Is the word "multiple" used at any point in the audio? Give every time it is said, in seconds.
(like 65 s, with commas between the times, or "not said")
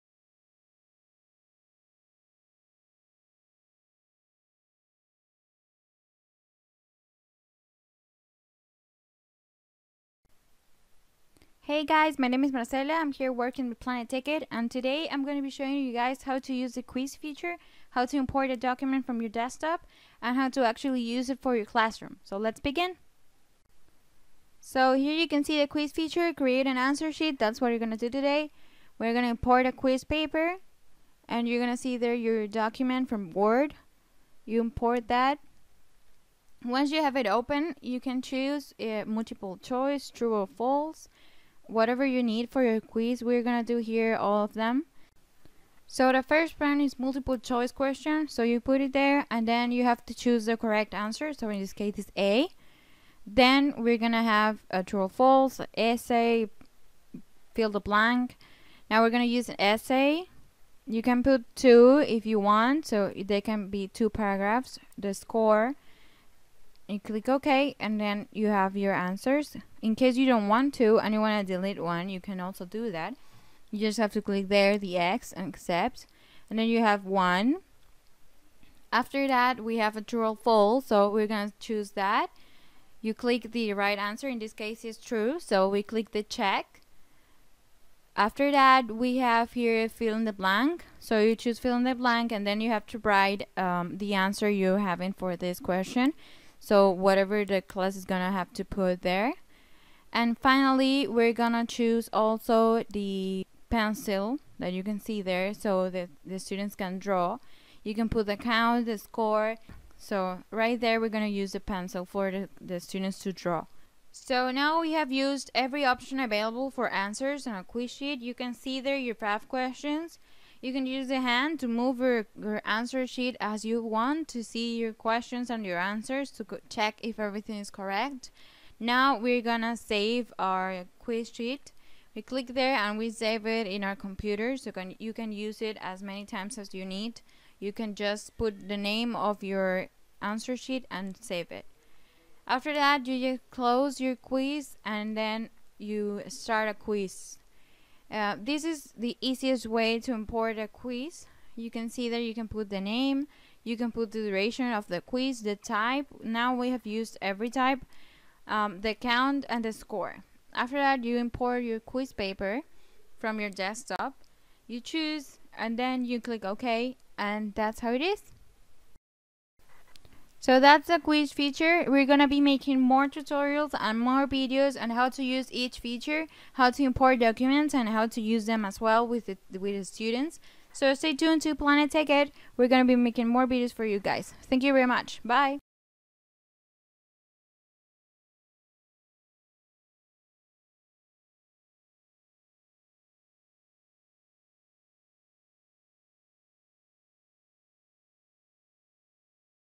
39 s, 46 s.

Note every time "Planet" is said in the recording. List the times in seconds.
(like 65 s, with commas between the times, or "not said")
13 s, 181 s.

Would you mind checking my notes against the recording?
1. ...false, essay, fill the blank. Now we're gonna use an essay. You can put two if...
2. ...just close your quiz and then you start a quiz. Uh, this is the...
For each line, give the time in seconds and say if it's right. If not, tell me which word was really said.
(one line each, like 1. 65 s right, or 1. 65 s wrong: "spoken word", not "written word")
1. 55 s right
2. 143 s right.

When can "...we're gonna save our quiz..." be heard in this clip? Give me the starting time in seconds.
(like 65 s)
129 s.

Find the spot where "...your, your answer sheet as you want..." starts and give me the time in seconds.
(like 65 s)
121 s.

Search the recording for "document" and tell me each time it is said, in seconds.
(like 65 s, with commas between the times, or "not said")
18 s, 32 s, 177 s.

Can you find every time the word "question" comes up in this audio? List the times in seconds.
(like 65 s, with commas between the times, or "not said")
47 s, 95 s, 119 s, 124 s.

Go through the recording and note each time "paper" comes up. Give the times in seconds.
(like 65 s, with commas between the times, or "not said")
30 s, 162 s.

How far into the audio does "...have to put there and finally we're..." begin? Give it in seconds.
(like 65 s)
98 s.